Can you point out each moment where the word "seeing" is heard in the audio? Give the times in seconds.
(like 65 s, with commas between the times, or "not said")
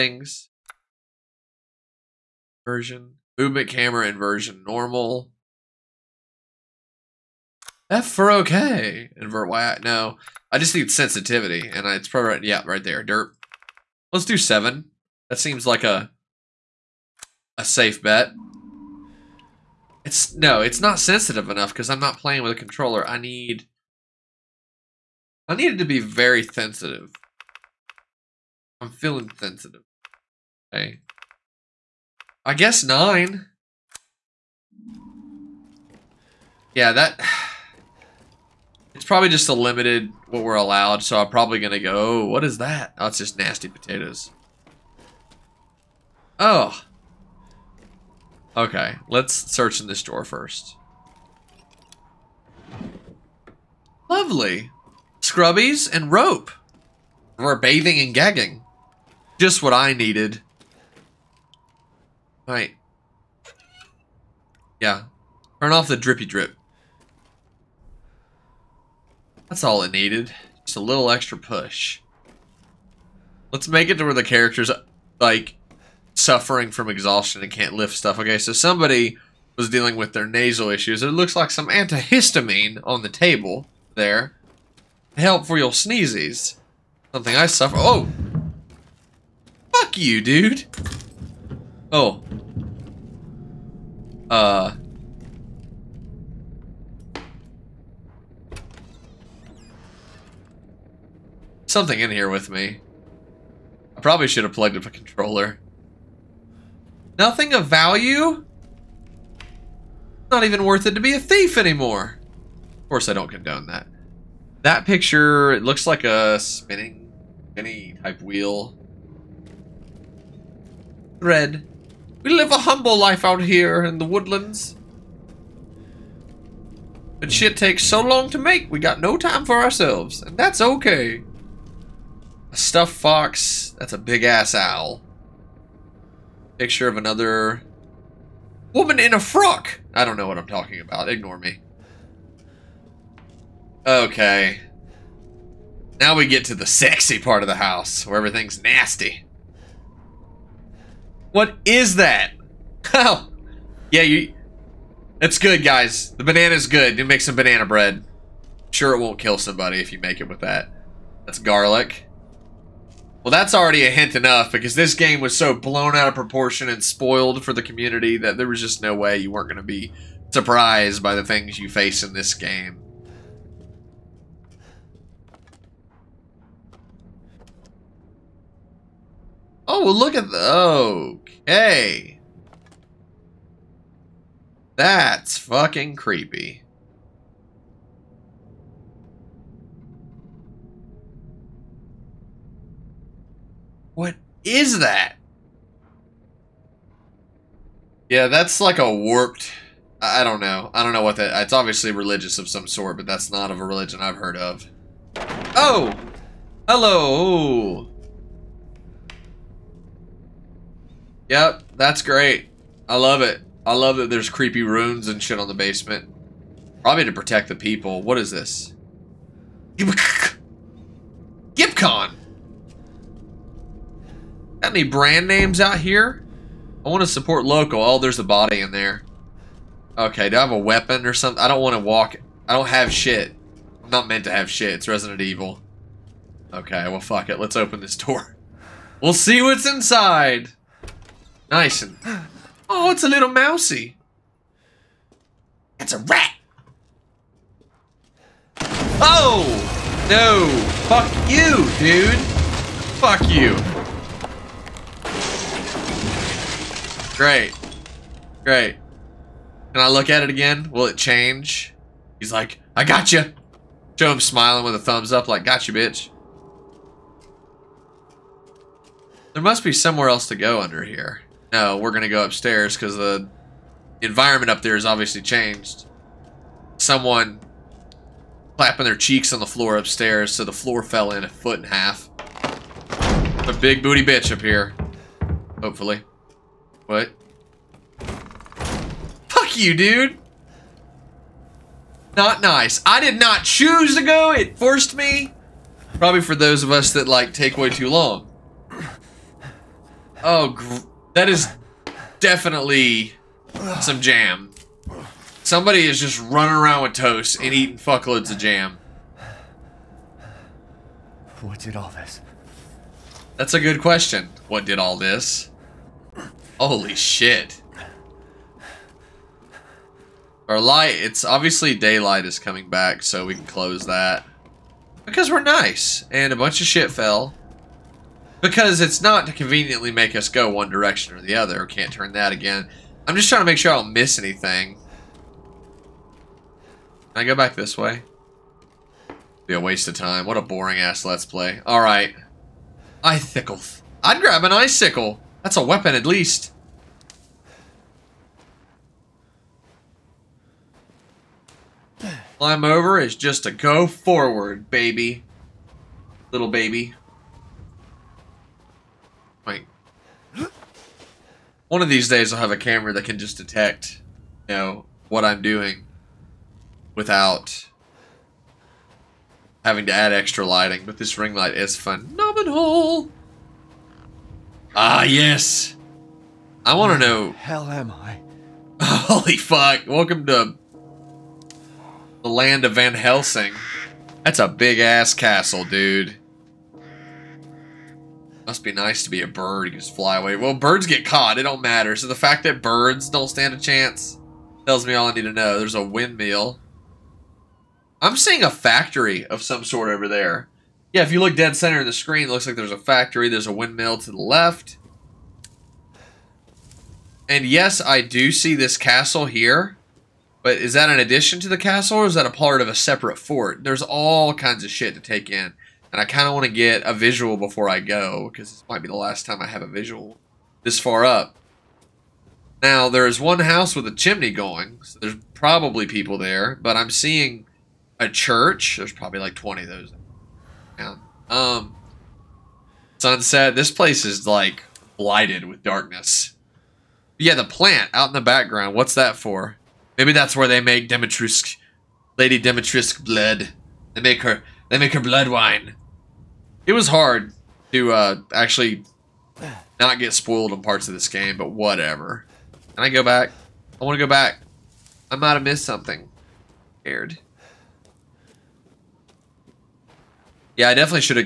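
398 s, 426 s.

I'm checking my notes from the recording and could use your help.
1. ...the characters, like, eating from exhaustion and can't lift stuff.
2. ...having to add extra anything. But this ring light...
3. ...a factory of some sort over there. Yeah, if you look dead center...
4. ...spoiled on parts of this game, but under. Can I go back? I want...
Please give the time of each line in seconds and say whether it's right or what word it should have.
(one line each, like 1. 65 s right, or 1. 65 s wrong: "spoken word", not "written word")
1. 74 s wrong: "suffering", not "eating"
2. 369 s wrong: "lighting", not "anything"
3. 398 s right
4. 450 s wrong: "whatever", not "under".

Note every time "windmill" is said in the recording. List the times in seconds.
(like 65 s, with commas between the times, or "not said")
395 s, 403 s.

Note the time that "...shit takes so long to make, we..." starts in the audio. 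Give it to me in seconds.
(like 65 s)
127 s.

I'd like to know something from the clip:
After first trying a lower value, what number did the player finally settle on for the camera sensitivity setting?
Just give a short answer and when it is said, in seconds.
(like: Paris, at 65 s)
9, at 32 s.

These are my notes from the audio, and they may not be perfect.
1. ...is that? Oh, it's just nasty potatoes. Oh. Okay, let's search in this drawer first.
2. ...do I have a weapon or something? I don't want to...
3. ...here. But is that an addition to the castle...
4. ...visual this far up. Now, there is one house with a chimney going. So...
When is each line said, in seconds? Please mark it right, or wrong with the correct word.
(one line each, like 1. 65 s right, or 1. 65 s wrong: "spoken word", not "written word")
1. 42 s right
2. 230 s right
3. 409 s right
4. 419 s right.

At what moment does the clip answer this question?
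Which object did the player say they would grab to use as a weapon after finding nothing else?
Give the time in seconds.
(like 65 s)
344 s.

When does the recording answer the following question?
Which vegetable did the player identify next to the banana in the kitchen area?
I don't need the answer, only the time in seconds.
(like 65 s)
161 s.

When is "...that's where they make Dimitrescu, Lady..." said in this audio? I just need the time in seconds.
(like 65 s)
440 s.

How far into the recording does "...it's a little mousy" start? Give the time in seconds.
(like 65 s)
242 s.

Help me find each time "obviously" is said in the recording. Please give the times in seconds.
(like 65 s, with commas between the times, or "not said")
201 s, 274 s, 321 s.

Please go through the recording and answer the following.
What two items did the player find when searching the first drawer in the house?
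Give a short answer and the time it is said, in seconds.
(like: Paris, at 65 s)
Scrubbies and rope, at 55 s.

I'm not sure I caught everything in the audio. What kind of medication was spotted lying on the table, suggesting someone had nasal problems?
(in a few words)
Antihistamine.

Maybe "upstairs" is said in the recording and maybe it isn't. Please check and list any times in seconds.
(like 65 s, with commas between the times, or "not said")
272 s, 279 s.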